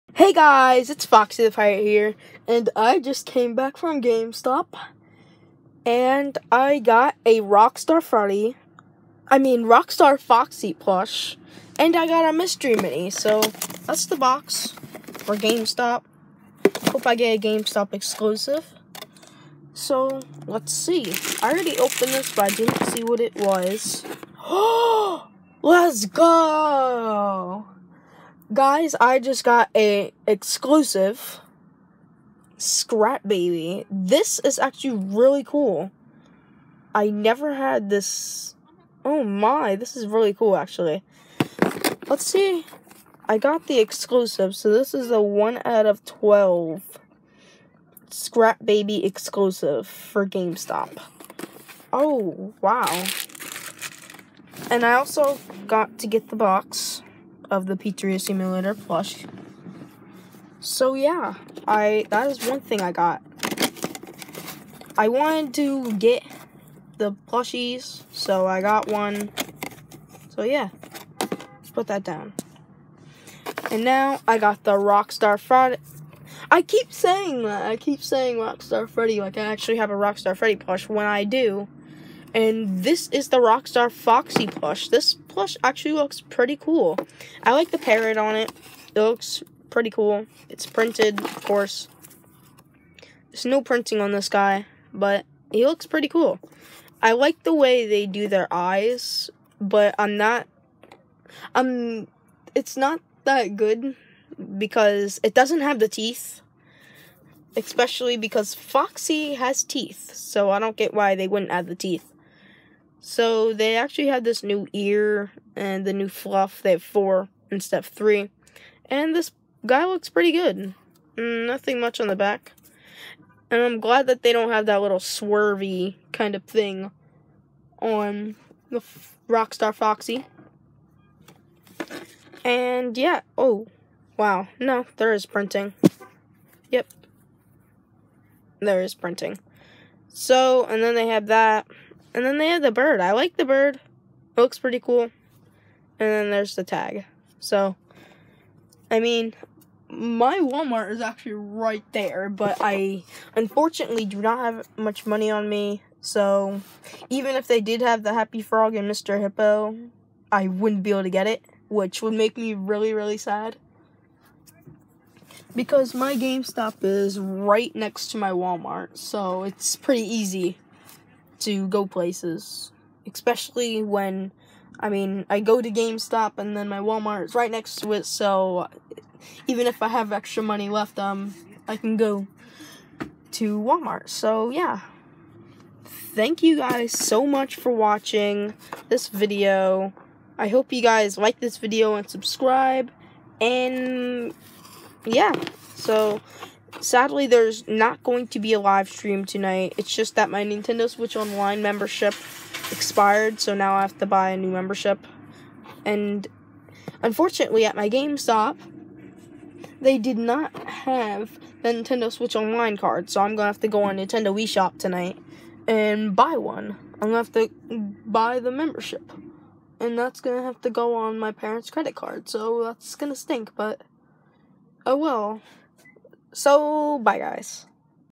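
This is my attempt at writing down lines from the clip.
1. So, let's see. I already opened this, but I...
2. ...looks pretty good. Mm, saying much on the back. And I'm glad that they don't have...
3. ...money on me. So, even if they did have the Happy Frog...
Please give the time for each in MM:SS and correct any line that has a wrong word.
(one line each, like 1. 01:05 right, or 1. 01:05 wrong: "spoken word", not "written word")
1. 00:19 right
2. 01:59 wrong: "nothing", not "saying"
3. 02:35 right.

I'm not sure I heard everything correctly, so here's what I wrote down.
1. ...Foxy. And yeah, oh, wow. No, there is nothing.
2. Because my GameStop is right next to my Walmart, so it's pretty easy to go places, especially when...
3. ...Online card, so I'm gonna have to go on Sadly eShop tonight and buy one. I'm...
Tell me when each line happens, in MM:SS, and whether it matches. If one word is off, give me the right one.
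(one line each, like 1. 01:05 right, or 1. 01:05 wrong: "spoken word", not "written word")
1. 02:09 wrong: "printing", not "nothing"
2. 02:45 right
3. 03:32 wrong: "Nintendo", not "Sadly".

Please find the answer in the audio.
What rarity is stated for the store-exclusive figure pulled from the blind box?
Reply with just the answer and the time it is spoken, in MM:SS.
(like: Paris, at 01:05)
1 out of 12, at 00:45.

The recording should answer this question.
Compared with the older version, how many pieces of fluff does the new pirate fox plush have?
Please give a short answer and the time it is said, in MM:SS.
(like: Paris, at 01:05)
4, at 01:56.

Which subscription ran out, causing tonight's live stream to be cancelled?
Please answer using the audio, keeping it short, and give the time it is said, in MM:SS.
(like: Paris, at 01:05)
Nintendo Switch Online membership, at 03:20.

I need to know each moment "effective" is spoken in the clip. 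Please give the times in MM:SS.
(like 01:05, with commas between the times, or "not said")
not said.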